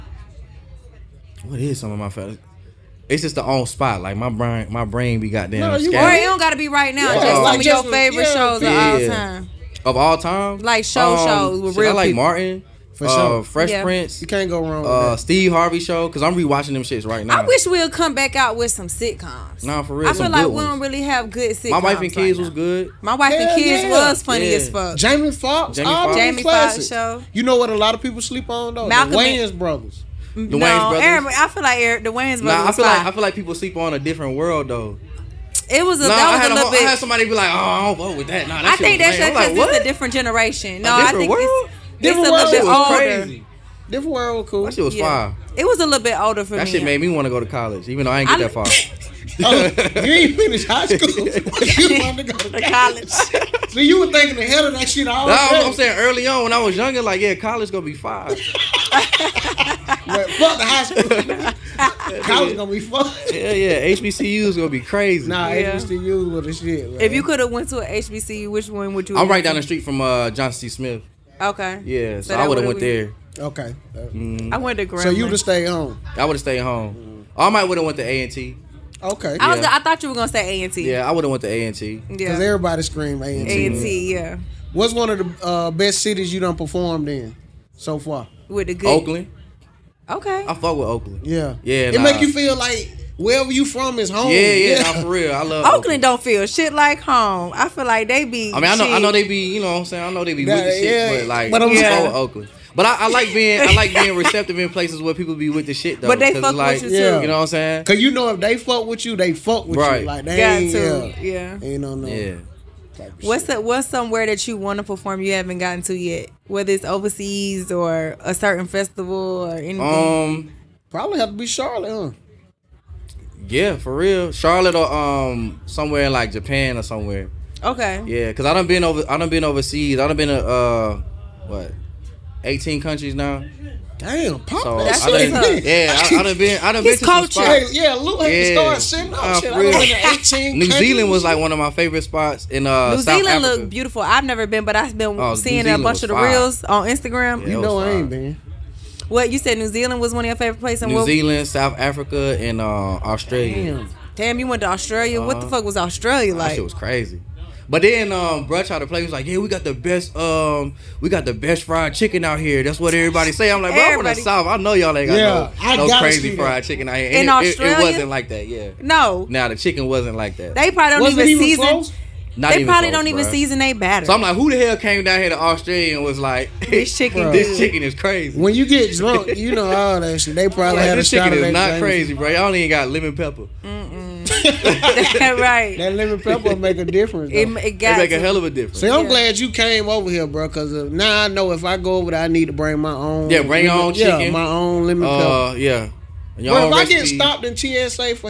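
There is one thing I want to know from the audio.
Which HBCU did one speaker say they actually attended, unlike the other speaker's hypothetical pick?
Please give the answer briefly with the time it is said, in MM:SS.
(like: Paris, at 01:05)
Grambling, at 01:14.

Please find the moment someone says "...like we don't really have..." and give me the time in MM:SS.
00:20.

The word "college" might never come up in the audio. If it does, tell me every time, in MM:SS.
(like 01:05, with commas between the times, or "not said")
00:47, 00:52, 00:57, 01:02.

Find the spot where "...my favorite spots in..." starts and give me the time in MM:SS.
02:21.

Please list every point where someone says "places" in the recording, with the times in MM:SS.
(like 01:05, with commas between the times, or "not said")
01:44, 02:30.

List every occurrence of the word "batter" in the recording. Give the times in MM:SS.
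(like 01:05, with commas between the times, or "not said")
02:53.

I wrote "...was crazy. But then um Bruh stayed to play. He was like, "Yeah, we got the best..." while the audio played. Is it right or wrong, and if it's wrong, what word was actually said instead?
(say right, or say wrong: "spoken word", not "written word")
wrong: "tried", not "stayed".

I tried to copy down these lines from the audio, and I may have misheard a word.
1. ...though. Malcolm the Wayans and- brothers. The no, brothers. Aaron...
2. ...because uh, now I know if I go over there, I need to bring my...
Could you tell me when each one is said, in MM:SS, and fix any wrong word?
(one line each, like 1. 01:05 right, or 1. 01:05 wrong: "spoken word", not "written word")
1. 00:28 right
2. 03:10 right.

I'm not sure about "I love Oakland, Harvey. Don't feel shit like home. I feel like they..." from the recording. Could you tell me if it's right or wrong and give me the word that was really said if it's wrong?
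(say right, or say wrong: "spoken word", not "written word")
wrong: "Oakland", not "Harvey".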